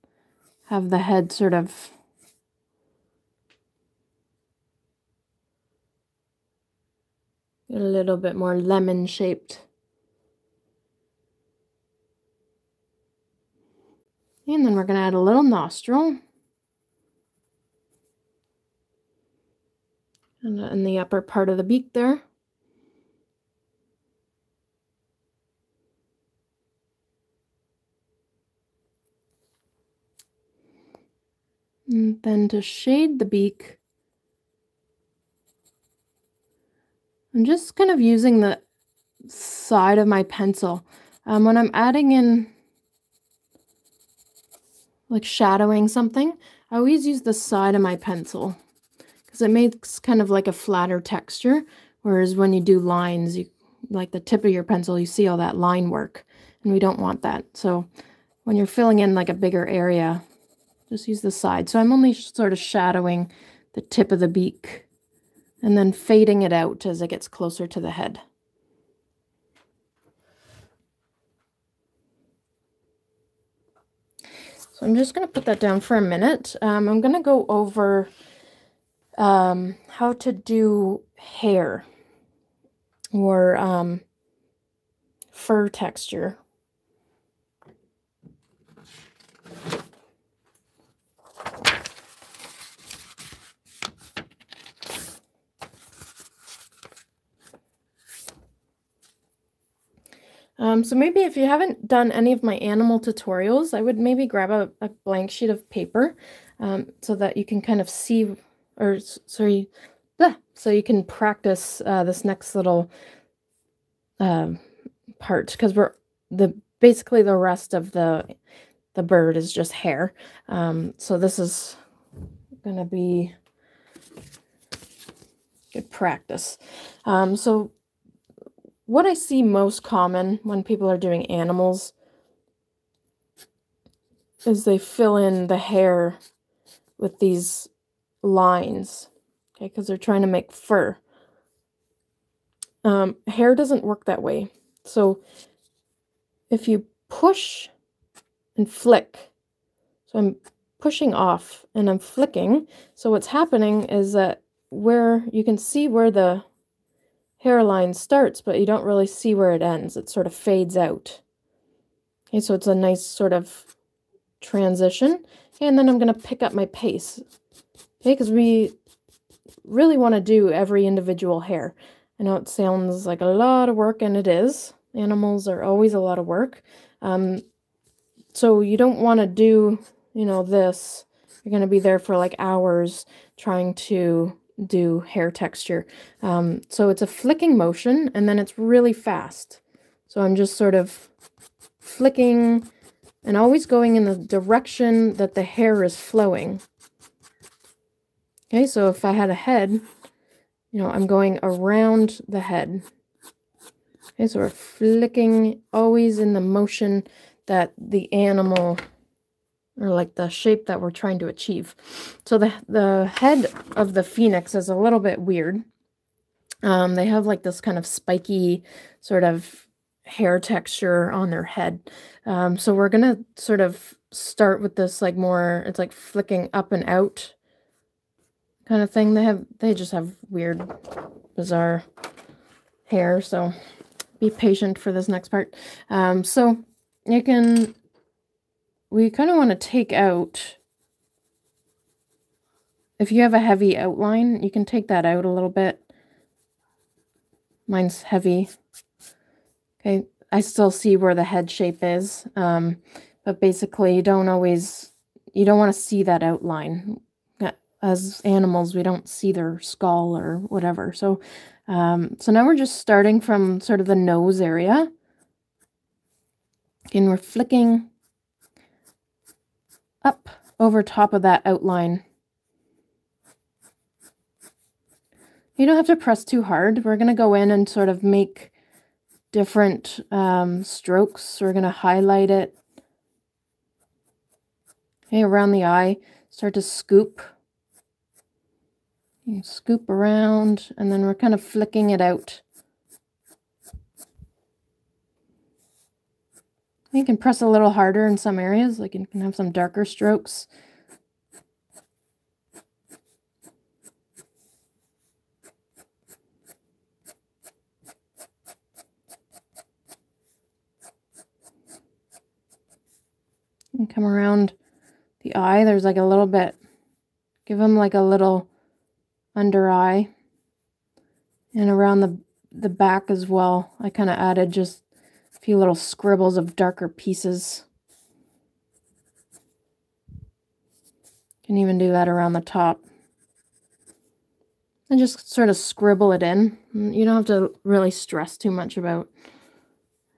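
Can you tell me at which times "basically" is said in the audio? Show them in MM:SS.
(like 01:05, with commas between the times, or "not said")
01:56, 04:13.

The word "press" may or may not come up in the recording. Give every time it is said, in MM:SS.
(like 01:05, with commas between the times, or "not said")
04:35, 04:57.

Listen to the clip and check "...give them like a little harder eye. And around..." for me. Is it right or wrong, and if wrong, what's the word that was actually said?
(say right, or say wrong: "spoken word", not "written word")
wrong: "under", not "harder".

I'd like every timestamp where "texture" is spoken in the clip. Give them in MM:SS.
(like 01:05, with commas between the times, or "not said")
00:50, 01:25, 03:05, 03:40.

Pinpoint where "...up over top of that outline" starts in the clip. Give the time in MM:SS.
04:30.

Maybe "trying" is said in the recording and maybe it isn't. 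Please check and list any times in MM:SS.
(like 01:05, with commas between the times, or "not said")
02:19, 03:03, 03:30.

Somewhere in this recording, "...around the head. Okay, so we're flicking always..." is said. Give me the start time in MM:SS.
03:21.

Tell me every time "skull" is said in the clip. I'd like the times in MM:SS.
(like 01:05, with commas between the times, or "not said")
04:19.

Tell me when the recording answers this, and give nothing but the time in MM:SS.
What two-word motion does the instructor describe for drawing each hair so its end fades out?
02:27.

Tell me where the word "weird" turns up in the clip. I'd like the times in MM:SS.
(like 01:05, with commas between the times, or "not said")
03:35, 03:50.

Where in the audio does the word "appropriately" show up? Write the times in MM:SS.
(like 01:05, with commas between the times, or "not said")
not said.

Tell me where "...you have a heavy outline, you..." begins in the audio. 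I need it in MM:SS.
04:03.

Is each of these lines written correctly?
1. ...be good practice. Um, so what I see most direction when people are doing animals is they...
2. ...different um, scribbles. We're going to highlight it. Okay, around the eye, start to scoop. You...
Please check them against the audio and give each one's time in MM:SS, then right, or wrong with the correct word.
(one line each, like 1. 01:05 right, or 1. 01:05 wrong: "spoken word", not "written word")
1. 02:02 wrong: "common", not "direction"
2. 04:39 wrong: "strokes", not "scribbles".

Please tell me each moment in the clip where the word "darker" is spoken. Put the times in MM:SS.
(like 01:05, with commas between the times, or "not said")
04:59, 05:26.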